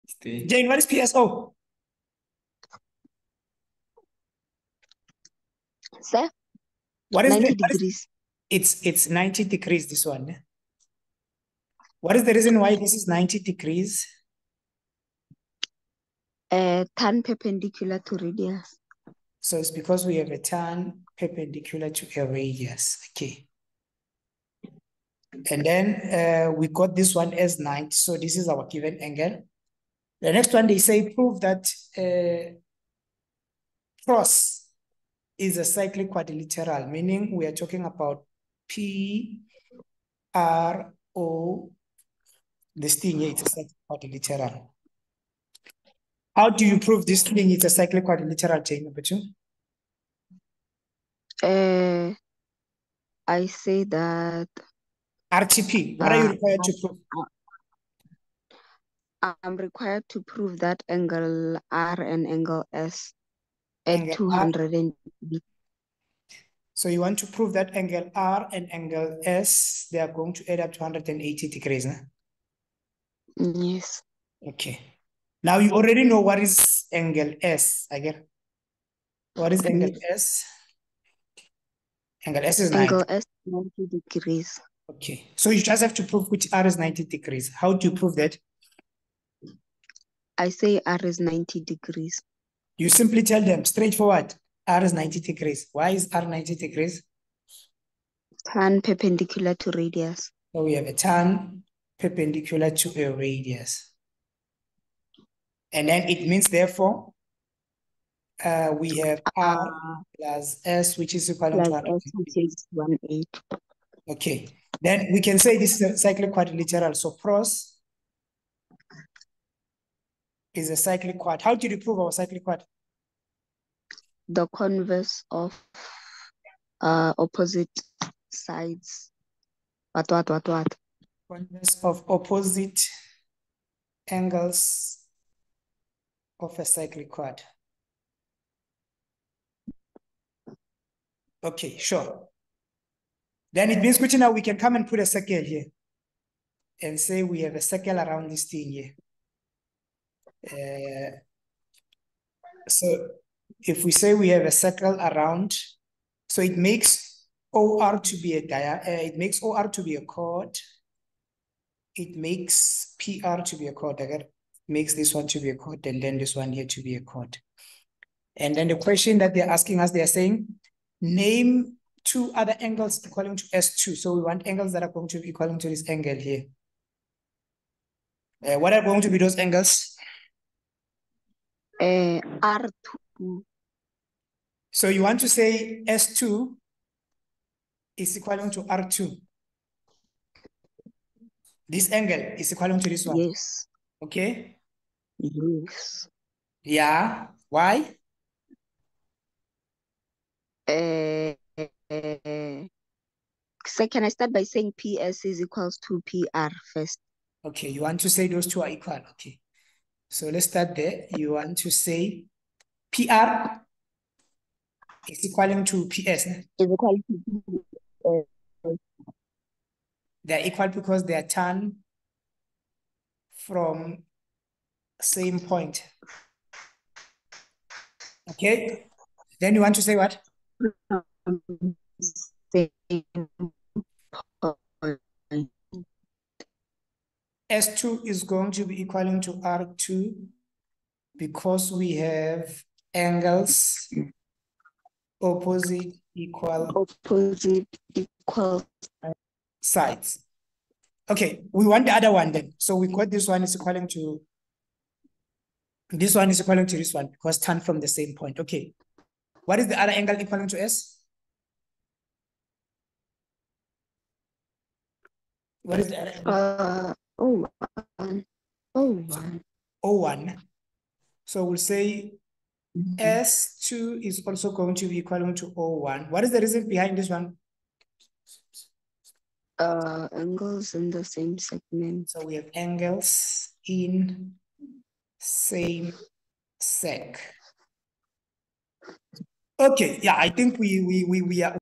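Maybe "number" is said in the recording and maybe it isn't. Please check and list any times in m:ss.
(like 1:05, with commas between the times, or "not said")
0:48.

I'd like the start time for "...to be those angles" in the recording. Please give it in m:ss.
2:59.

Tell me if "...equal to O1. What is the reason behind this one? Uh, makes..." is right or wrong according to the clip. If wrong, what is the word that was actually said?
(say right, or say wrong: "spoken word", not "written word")
wrong: "angles", not "makes".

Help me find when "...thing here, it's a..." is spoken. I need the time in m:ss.
0:42.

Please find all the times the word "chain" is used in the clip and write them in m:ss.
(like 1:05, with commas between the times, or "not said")
0:48.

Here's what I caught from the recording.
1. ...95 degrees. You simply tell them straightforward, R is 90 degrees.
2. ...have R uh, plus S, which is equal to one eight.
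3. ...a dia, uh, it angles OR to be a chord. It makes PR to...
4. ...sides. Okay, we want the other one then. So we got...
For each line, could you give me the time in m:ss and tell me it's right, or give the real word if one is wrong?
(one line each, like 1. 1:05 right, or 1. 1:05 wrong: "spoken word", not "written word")
1. 1:31 wrong: "90", not "95"
2. 1:48 right
3. 2:38 wrong: "makes", not "angles"
4. 4:09 right.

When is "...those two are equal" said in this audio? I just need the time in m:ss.
3:28.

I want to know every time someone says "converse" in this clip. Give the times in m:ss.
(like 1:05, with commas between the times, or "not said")
2:04, 2:11.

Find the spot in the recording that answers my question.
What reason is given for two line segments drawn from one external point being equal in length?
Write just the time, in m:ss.
3:41.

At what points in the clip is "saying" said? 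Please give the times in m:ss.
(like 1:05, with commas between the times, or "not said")
2:50, 3:24.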